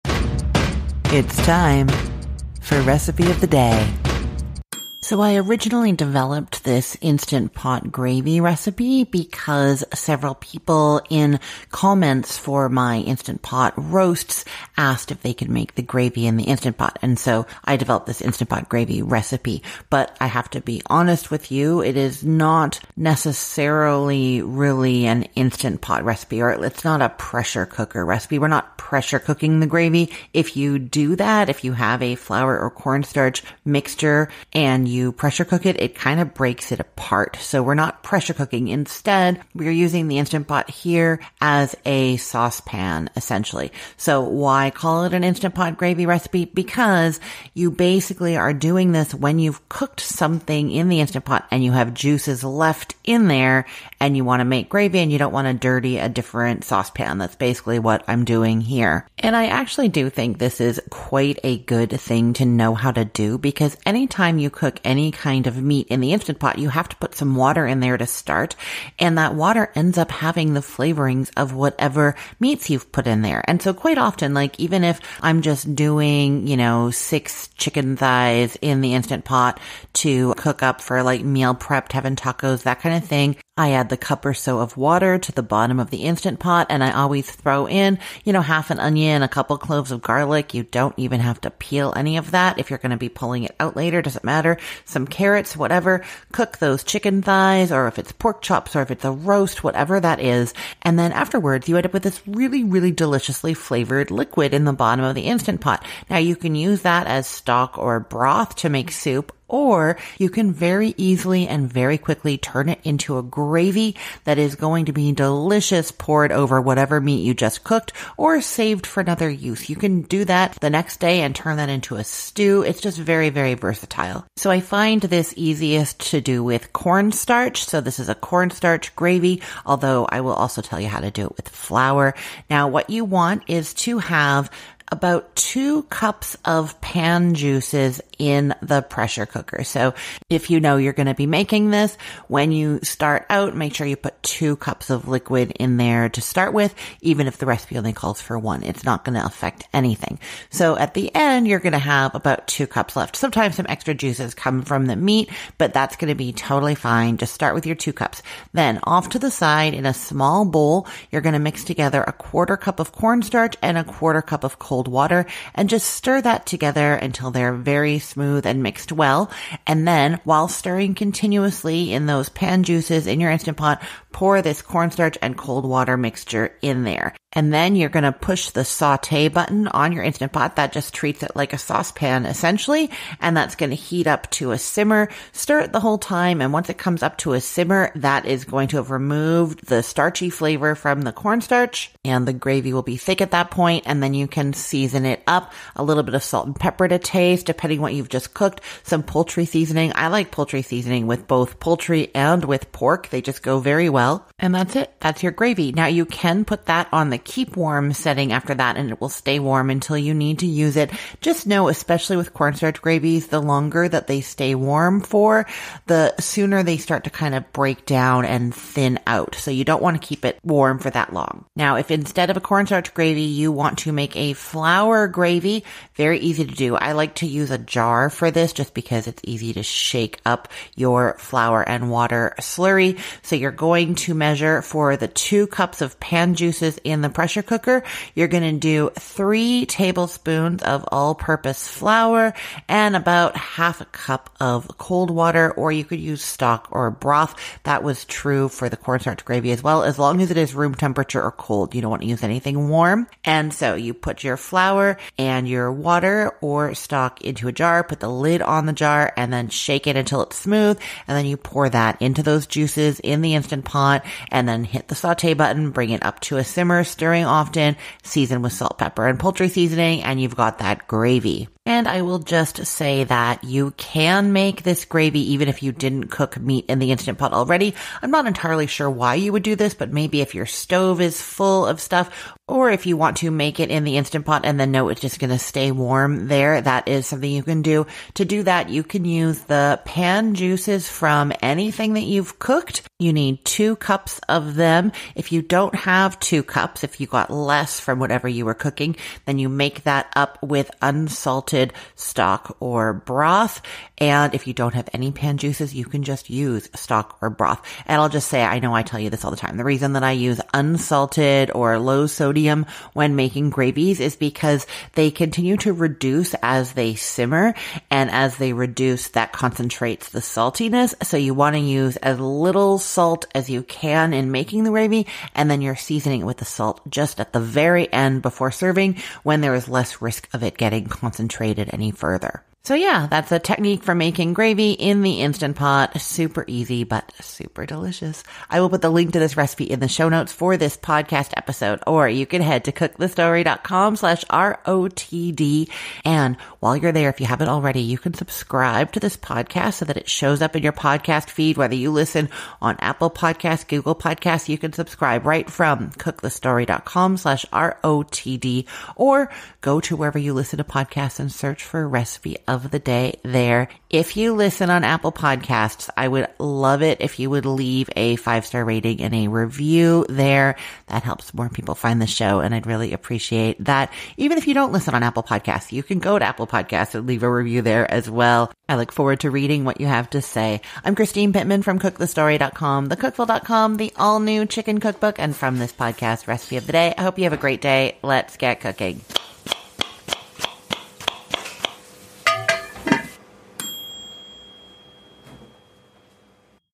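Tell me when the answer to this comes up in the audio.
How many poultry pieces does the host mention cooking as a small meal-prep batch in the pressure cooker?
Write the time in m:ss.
1:16.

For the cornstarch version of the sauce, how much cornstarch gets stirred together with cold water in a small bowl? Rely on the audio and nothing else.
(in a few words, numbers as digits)
1/4 cup.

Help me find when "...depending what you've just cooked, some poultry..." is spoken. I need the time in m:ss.
3:17.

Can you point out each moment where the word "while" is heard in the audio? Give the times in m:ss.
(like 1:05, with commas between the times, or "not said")
2:50, 5:46.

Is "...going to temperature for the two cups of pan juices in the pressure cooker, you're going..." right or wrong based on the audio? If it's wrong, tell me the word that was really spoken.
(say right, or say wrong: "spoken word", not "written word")
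wrong: "measure", not "temperature".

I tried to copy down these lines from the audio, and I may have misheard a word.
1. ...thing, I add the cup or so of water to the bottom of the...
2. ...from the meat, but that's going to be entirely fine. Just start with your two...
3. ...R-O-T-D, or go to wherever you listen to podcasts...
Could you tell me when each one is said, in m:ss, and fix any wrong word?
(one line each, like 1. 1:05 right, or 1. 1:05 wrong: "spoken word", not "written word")
1. 1:23 right
2. 2:34 wrong: "totally", not "entirely"
3. 5:57 right.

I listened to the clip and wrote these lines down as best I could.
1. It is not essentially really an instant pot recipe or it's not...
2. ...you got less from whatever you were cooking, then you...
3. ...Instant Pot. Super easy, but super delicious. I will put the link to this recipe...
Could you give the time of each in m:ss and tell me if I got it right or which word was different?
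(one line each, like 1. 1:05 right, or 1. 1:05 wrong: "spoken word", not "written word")
1. 0:21 wrong: "necessarily", not "essentially"
2. 4:56 right
3. 5:35 right.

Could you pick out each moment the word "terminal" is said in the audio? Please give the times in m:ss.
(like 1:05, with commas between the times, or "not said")
not said.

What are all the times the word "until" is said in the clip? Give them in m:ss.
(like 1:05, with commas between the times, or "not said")
2:46, 3:29, 4:19.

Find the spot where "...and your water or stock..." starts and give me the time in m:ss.
4:15.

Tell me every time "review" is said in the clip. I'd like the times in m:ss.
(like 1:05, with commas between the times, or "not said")
6:09, 6:17.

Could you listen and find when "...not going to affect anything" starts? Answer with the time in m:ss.
2:28.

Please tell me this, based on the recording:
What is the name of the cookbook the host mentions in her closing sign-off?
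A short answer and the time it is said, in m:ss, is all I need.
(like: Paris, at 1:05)
The All New Chicken Cookbook, at 6:23.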